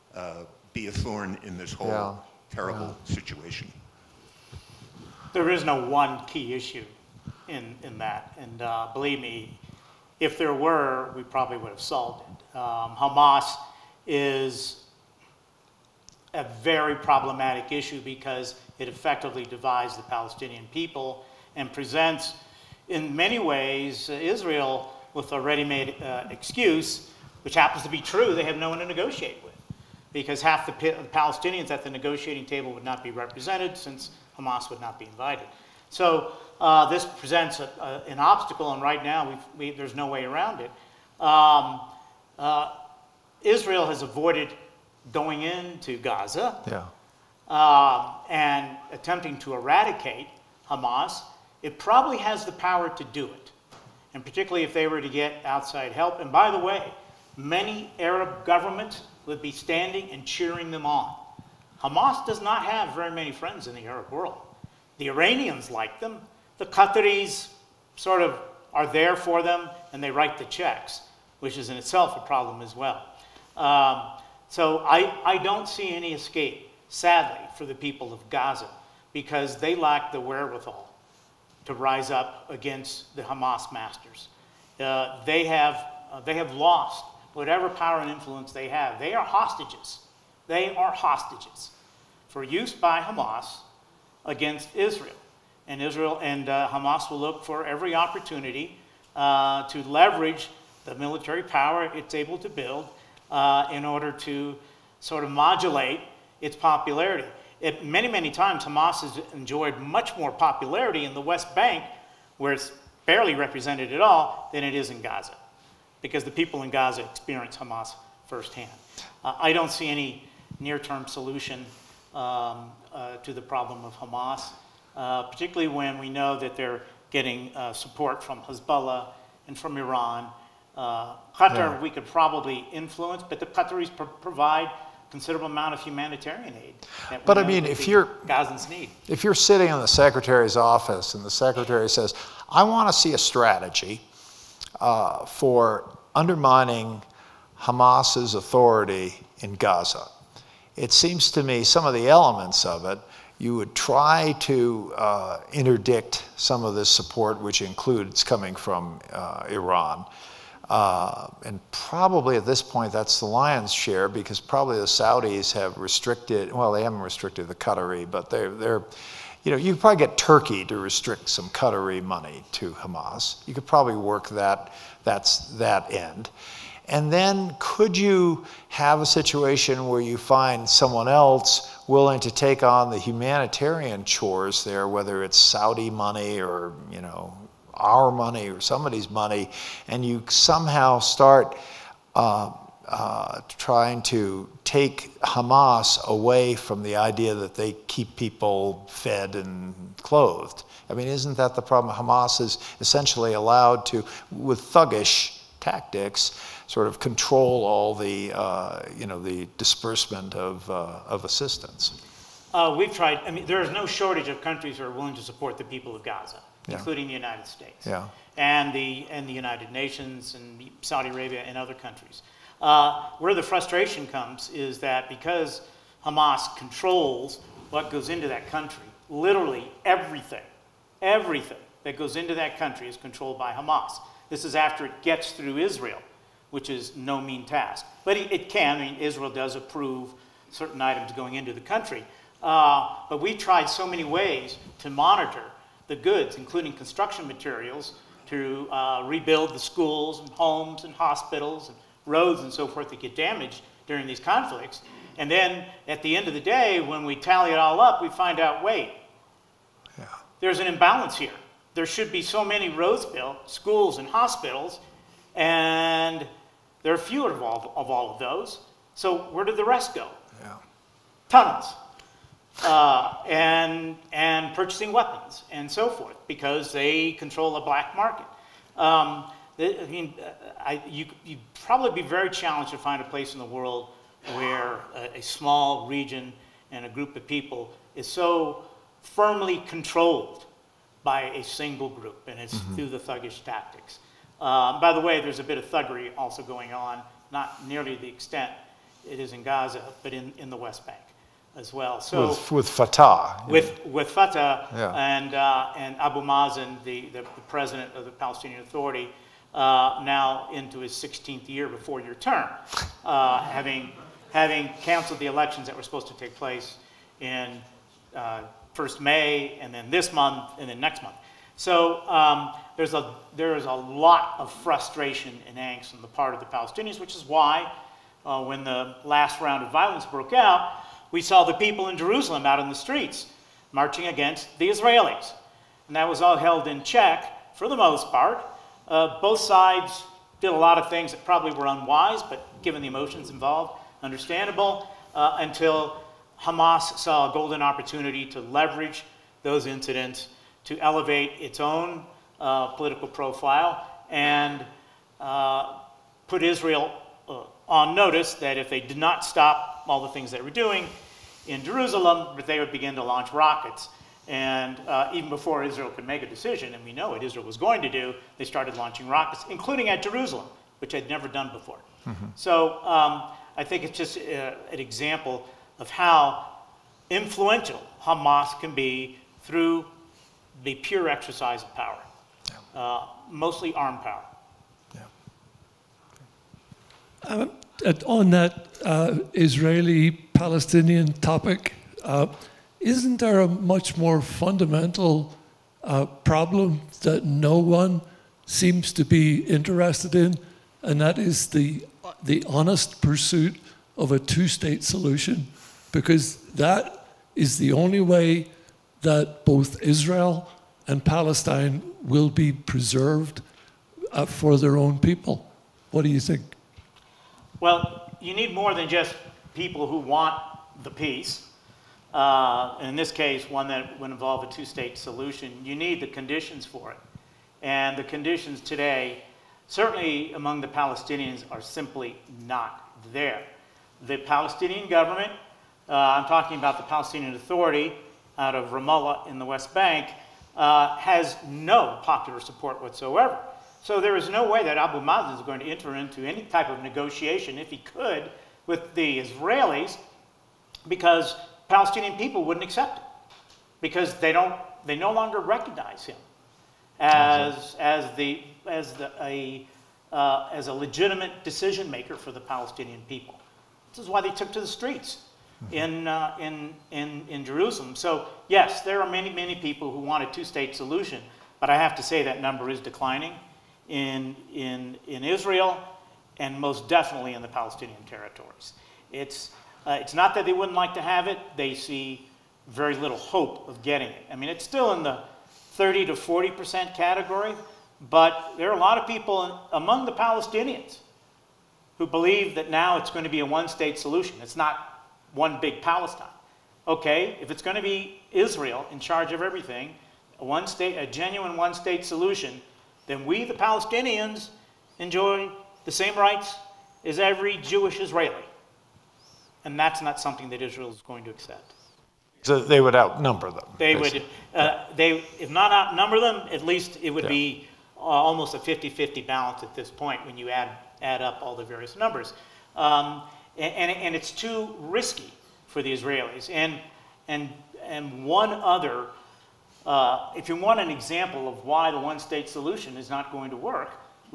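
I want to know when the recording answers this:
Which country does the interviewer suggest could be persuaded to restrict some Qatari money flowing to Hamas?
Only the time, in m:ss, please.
2:50.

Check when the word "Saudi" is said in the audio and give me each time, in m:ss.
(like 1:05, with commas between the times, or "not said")
2:44, 3:05, 3:40.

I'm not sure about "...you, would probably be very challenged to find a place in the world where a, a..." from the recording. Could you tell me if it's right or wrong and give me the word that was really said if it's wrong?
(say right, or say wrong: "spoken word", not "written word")
right.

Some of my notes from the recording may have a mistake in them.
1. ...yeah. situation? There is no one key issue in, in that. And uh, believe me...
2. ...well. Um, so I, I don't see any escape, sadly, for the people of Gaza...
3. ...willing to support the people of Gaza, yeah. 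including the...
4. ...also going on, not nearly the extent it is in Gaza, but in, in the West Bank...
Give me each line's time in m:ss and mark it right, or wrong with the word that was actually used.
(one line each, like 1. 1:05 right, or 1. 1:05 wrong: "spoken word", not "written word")
1. 0:03 right
2. 1:12 right
3. 3:34 right
4. 4:56 right.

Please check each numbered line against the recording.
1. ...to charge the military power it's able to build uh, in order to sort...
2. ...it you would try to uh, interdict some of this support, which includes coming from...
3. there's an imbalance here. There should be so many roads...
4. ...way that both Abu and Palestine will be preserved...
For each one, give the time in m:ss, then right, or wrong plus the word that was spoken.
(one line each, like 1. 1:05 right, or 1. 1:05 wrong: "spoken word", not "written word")
1. 1:39 wrong: "leverage", not "charge"
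2. 2:32 right
3. 4:20 right
4. 6:48 wrong: "Israel", not "Abu".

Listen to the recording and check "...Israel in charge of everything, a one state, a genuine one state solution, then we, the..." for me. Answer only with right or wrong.
right.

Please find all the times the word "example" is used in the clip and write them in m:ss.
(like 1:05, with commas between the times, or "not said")
6:14, 8:50.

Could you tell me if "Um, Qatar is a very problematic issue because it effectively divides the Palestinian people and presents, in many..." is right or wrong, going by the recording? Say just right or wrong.
wrong.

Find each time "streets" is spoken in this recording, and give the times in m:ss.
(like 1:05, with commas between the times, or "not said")
5:32, 7:44.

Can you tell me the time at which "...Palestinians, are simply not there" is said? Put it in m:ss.
7:10.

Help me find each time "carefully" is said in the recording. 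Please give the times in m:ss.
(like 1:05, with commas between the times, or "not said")
not said.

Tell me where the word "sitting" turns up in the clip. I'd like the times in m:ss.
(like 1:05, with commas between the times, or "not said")
2:19.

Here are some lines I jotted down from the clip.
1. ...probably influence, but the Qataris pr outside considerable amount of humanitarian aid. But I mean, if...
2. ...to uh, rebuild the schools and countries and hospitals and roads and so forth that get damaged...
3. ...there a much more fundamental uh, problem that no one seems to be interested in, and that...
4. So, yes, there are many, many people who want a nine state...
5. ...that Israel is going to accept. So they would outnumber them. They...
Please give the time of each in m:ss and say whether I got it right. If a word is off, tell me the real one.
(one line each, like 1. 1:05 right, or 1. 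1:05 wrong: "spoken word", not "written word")
1. 2:12 wrong: "provide", not "outside"
2. 4:08 wrong: "homes", not "countries"
3. 6:33 right
4. 7:47 wrong: "two", not "nine"
5. 8:30 right.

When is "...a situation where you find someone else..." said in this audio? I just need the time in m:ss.
2:59.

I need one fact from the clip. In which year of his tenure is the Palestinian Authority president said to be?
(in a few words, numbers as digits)
16th year.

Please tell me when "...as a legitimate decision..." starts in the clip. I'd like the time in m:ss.
7:40.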